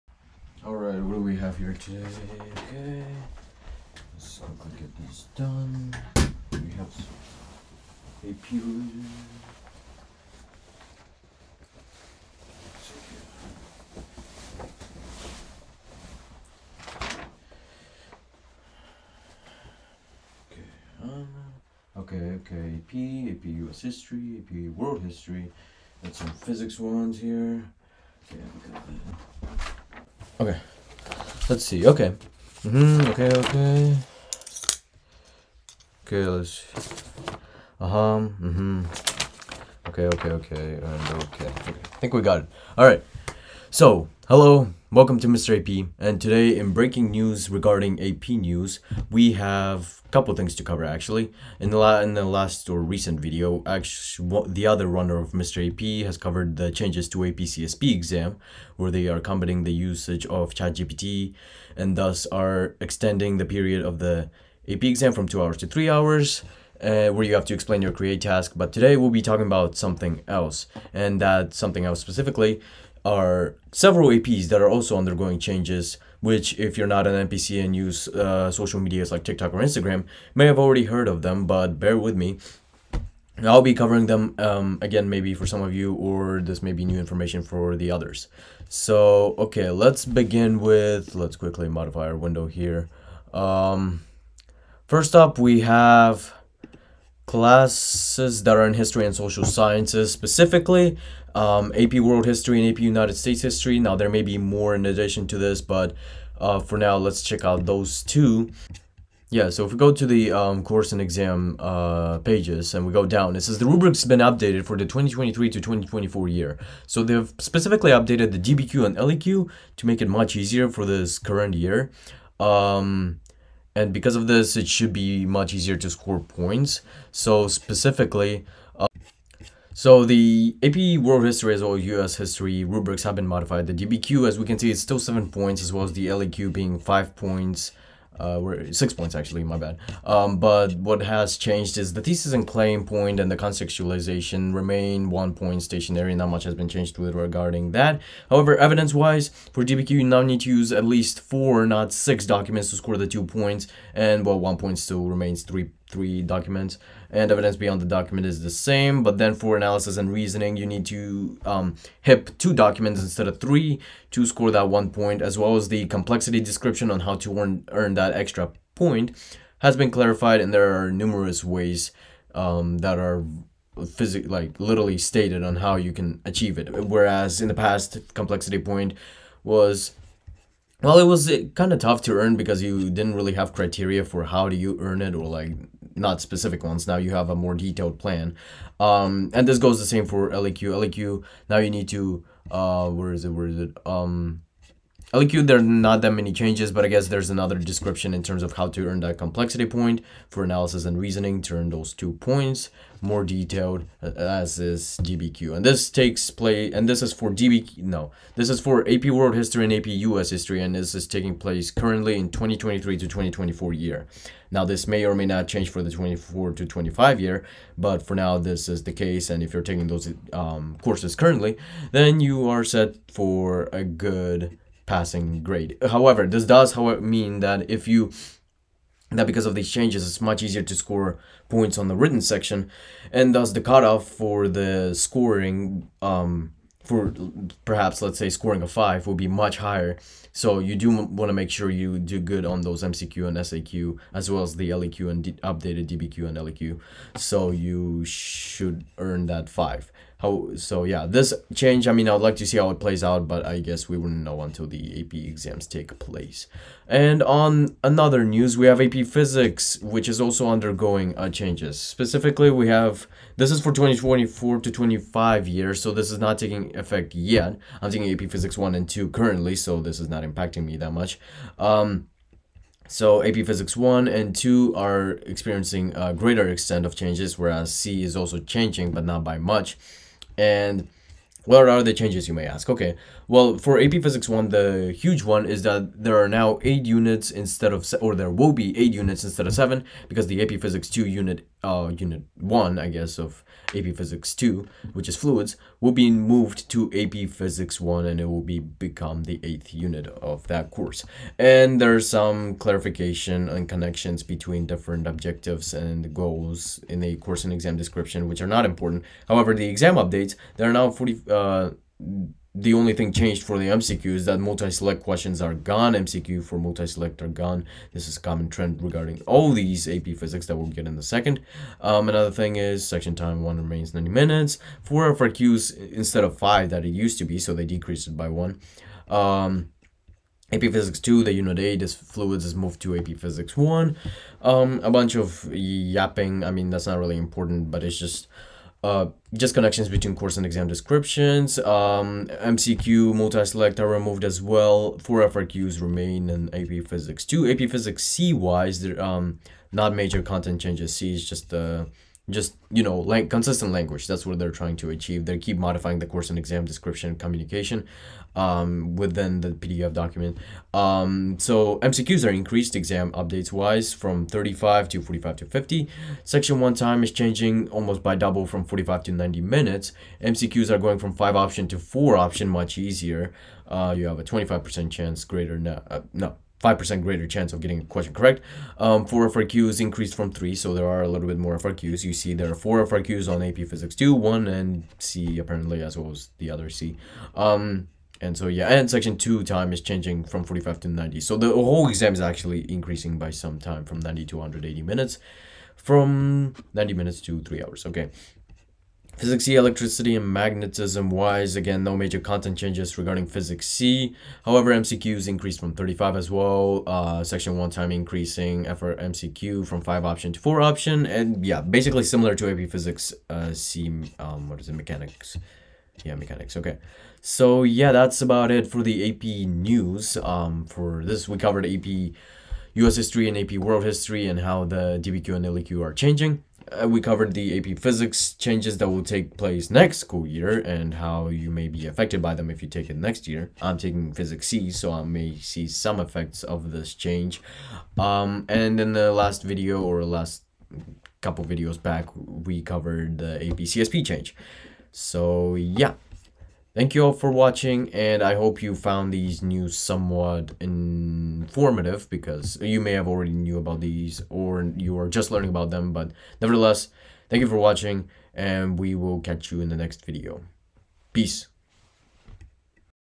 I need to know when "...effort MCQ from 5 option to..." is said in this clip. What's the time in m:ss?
6:48.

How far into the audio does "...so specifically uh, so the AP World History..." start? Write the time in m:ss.
2:07.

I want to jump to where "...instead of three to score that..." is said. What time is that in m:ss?
2:43.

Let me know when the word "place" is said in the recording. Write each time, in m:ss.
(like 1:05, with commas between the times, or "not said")
3:26, 3:31, 4:15, 7:09.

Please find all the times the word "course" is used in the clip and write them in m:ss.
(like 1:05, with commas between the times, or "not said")
1:50, 3:40, 5:00, 5:07, 5:40, 5:56.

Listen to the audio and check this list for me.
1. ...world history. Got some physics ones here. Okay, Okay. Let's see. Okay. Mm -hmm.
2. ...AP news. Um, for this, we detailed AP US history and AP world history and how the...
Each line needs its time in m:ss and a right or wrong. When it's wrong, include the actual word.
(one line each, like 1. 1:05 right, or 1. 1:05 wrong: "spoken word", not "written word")
1. 0:24 right
2. 6:59 wrong: "covered", not "detailed".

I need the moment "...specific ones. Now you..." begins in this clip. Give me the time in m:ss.
3:06.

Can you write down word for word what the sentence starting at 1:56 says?
So they've specifically updated the DBQ and LEQ to make it much easier for this current year.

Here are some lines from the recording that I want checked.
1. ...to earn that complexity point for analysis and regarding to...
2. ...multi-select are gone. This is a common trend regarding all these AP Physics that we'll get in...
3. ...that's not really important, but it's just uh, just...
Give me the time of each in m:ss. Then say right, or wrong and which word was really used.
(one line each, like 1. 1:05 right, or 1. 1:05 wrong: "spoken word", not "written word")
1. 3:18 wrong: "reasoning", not "regarding"
2. 5:16 right
3. 5:36 right.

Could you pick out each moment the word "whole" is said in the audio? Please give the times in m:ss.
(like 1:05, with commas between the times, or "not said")
6:31.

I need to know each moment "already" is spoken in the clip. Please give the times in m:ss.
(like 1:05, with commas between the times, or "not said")
1:20, 7:33.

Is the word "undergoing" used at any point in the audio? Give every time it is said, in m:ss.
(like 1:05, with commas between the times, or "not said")
1:14, 4:20.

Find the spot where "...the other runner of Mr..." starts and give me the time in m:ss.
0:54.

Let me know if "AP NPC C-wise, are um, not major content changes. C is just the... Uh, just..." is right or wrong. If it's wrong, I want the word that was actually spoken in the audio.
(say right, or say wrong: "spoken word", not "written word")
wrong: "Physics", not "NPC".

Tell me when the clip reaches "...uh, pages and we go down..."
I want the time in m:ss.
1:51.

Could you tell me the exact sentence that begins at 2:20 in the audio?
Um, but what has changed is the thesis and claim point and the contextualization remain one point stationary.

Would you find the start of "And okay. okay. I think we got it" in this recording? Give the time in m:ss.
0:40.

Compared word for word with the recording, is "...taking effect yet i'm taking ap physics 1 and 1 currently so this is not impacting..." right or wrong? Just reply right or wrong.
wrong.